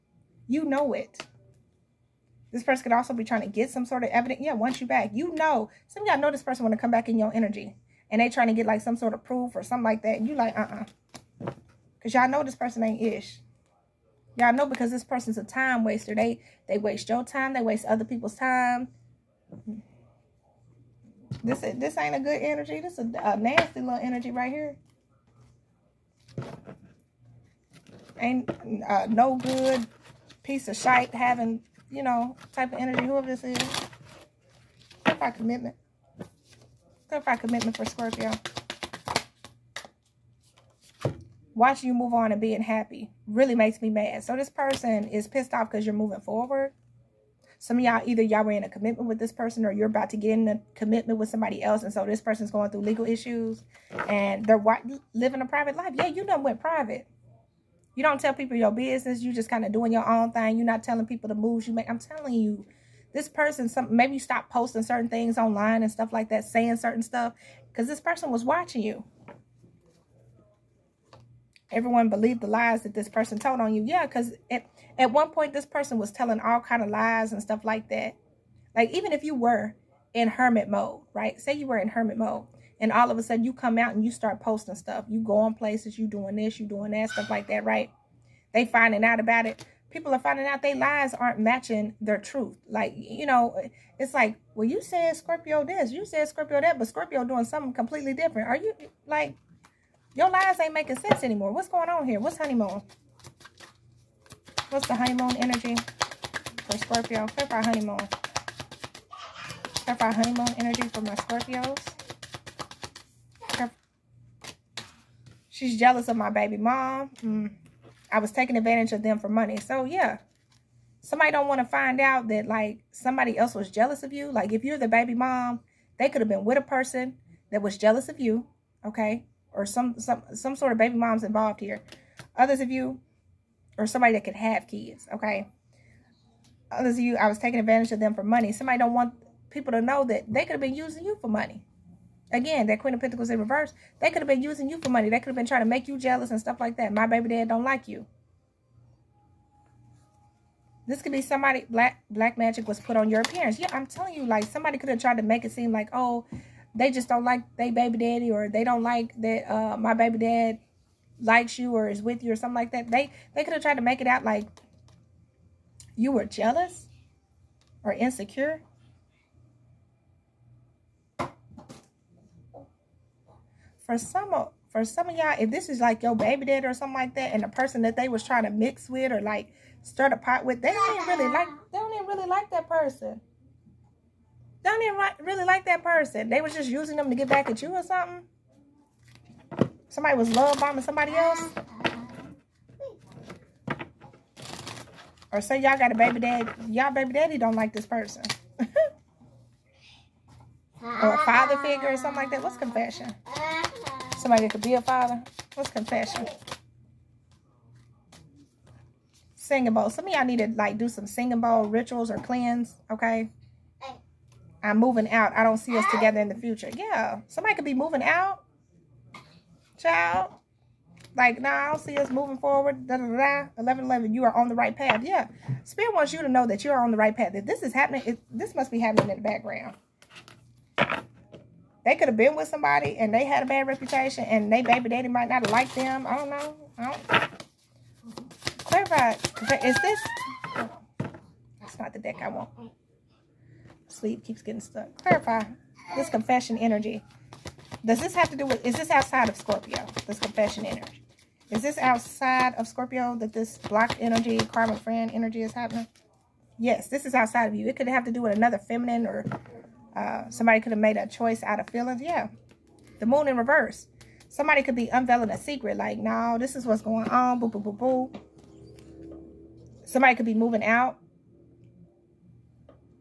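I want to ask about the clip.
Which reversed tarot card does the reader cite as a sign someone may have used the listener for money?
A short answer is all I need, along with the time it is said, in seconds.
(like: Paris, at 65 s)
Queen of Pentacles, at 142 s.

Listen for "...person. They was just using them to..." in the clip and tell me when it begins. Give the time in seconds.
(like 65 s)
185 s.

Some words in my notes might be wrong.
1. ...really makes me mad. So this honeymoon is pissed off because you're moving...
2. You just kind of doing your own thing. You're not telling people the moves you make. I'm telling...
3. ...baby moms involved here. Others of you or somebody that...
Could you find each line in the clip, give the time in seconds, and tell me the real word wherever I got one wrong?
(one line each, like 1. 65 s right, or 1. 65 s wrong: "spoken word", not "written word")
1. 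43 s wrong: "person", not "honeymoon"
2. 59 s right
3. 130 s right.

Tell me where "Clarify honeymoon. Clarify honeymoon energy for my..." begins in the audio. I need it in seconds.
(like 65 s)
107 s.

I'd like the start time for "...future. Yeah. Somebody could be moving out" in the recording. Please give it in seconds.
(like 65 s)
216 s.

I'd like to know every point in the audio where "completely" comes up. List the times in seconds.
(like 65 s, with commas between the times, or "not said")
97 s.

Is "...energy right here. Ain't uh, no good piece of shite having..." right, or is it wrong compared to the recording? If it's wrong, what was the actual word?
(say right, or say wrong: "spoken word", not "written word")
right.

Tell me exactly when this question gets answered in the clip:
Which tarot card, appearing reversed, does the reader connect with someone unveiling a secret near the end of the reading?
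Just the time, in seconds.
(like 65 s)
262 s.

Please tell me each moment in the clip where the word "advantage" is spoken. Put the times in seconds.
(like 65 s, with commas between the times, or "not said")
118 s, 137 s.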